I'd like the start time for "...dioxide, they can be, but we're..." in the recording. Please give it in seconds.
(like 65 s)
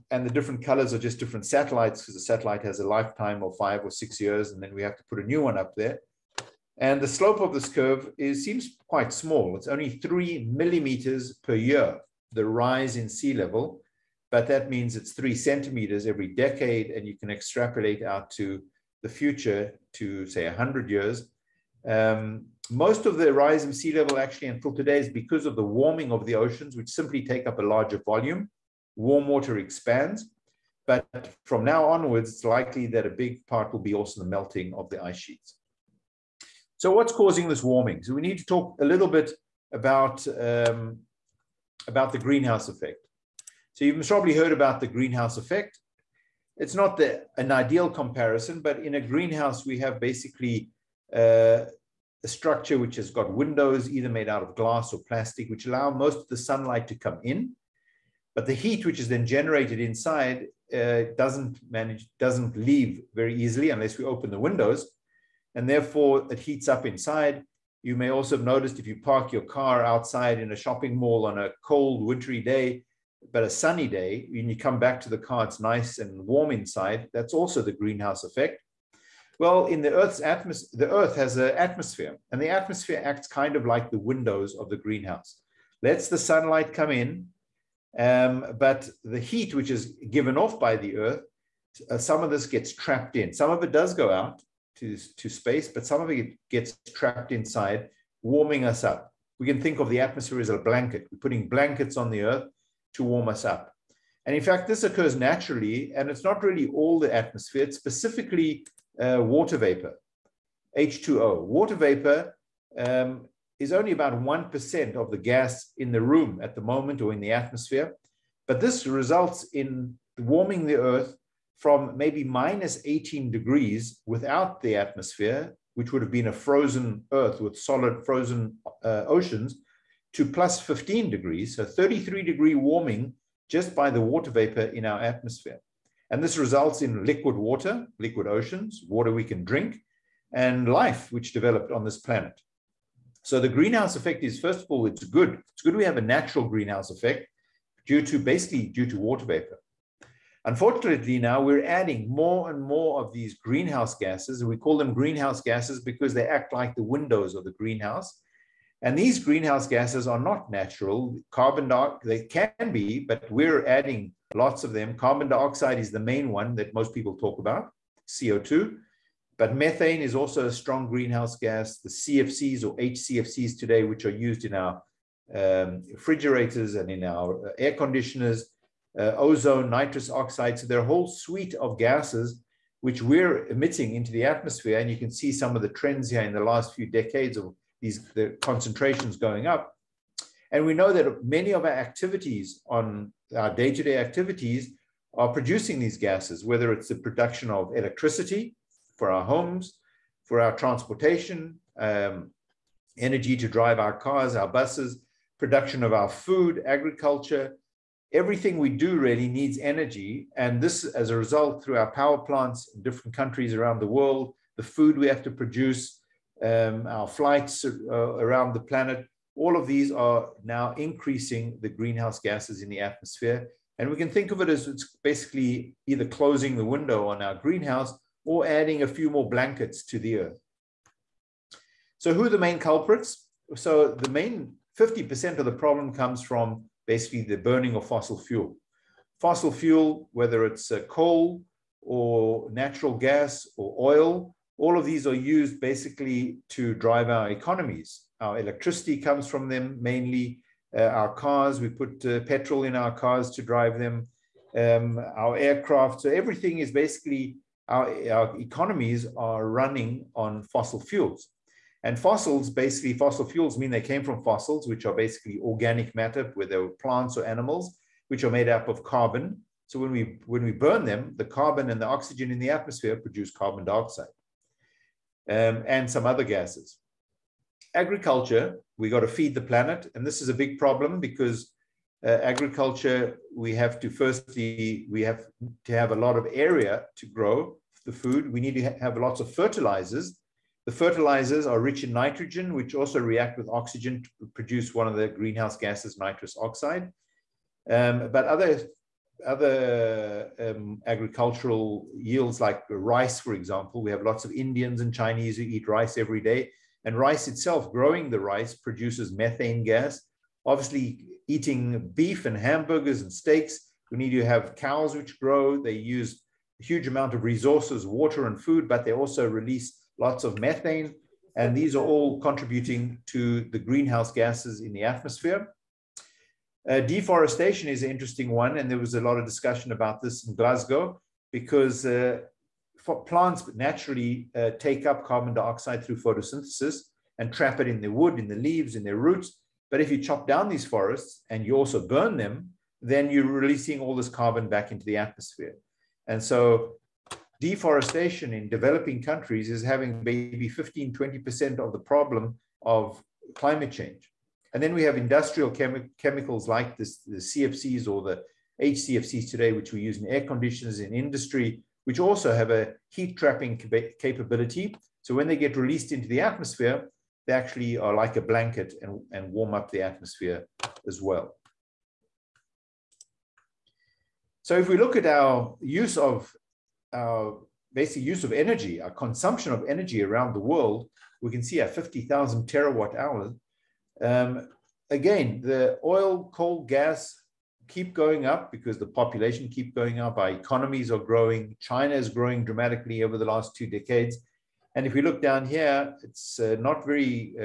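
161 s.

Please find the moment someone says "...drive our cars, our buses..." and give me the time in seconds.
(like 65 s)
203 s.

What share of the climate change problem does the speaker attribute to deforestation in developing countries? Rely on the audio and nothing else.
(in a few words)
15-20%.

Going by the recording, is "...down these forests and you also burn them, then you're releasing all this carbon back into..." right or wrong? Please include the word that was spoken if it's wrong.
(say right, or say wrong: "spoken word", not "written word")
right.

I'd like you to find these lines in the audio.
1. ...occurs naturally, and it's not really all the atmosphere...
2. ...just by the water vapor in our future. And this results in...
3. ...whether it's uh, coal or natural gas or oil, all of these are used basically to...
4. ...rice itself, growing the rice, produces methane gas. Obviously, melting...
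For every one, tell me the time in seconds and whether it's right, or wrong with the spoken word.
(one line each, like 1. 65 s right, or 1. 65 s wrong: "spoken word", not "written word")
1. 104 s right
2. 133 s wrong: "atmosphere", not "future"
3. 240 s right
4. 306 s wrong: "eating", not "melting".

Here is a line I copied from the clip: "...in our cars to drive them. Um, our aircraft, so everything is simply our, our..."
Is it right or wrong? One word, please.
wrong.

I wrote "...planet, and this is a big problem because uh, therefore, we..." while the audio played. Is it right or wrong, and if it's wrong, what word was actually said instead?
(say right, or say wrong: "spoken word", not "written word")
wrong: "agriculture", not "therefore".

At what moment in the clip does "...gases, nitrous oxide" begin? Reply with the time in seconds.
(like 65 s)
295 s.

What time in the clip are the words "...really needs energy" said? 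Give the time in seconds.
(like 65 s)
209 s.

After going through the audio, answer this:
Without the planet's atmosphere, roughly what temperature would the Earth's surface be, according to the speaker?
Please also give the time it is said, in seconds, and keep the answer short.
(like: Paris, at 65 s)
-18 degrees, at 122 s.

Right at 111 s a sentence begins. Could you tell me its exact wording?
Water vapor um, is only about 1% of the gas in the room at the moment or in the atmosphere.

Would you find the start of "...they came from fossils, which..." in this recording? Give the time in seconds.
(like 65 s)
263 s.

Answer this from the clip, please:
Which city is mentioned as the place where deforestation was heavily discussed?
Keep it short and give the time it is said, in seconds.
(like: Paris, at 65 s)
Glasgow, at 330 s.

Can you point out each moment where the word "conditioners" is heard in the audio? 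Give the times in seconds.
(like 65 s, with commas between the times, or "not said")
177 s, 360 s.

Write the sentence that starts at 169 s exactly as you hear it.
But methane is also a strong greenhouse gas.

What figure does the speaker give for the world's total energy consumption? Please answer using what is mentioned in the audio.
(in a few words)
50,000 terawatt hours.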